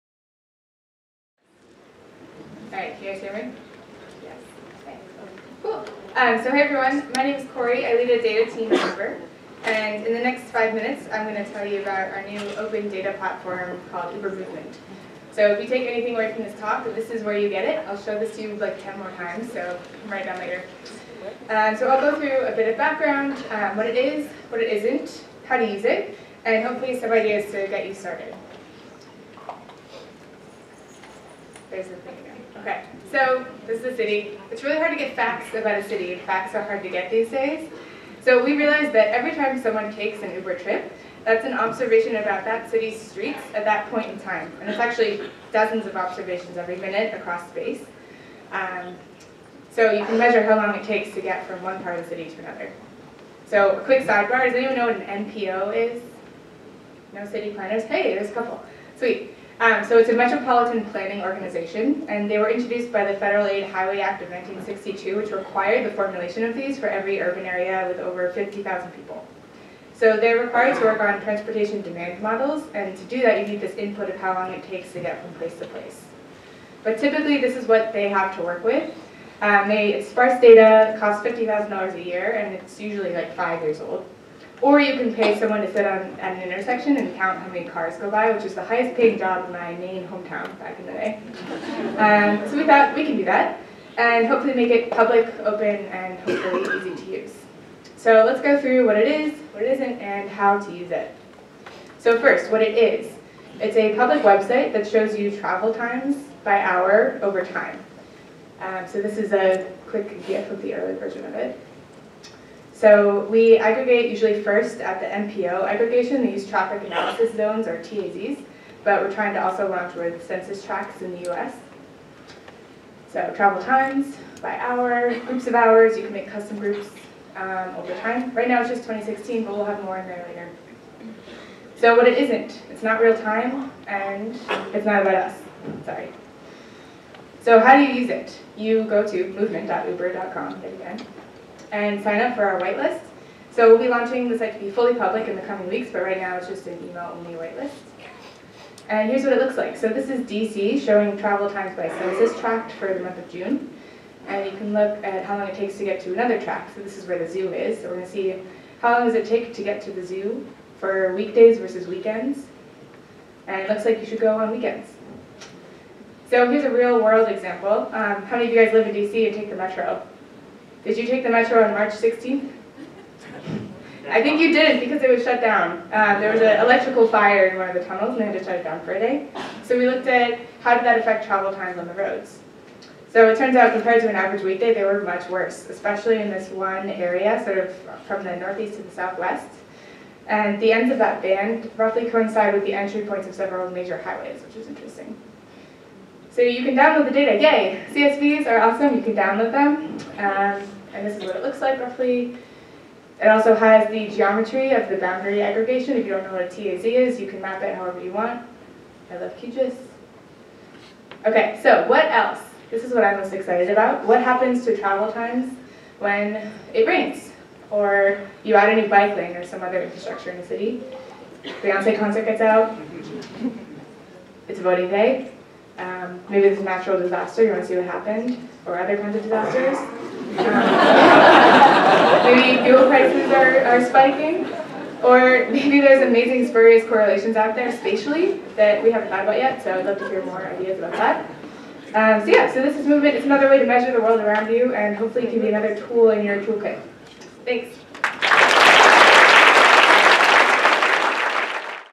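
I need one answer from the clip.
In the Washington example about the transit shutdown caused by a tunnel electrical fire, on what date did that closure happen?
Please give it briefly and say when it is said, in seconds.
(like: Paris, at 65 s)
March 16th, at 171 s.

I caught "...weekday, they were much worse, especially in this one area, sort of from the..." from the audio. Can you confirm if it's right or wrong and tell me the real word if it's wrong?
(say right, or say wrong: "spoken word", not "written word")
right.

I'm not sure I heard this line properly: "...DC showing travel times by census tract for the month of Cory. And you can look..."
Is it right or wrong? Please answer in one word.
wrong.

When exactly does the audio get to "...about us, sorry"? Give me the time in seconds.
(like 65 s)
135 s.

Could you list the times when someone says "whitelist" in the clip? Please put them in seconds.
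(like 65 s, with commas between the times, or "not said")
142 s, 147 s.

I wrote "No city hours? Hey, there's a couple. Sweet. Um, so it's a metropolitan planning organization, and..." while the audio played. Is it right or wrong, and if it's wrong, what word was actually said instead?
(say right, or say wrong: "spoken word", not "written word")
wrong: "planners", not "hours".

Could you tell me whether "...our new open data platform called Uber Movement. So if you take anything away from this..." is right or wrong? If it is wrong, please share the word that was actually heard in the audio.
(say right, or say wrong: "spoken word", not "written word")
right.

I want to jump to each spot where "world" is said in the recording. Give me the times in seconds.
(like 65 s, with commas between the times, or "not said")
167 s, 244 s.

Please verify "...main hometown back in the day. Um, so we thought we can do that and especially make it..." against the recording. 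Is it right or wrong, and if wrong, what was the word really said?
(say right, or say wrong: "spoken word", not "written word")
wrong: "hopefully", not "especially".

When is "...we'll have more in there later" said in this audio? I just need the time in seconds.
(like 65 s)
129 s.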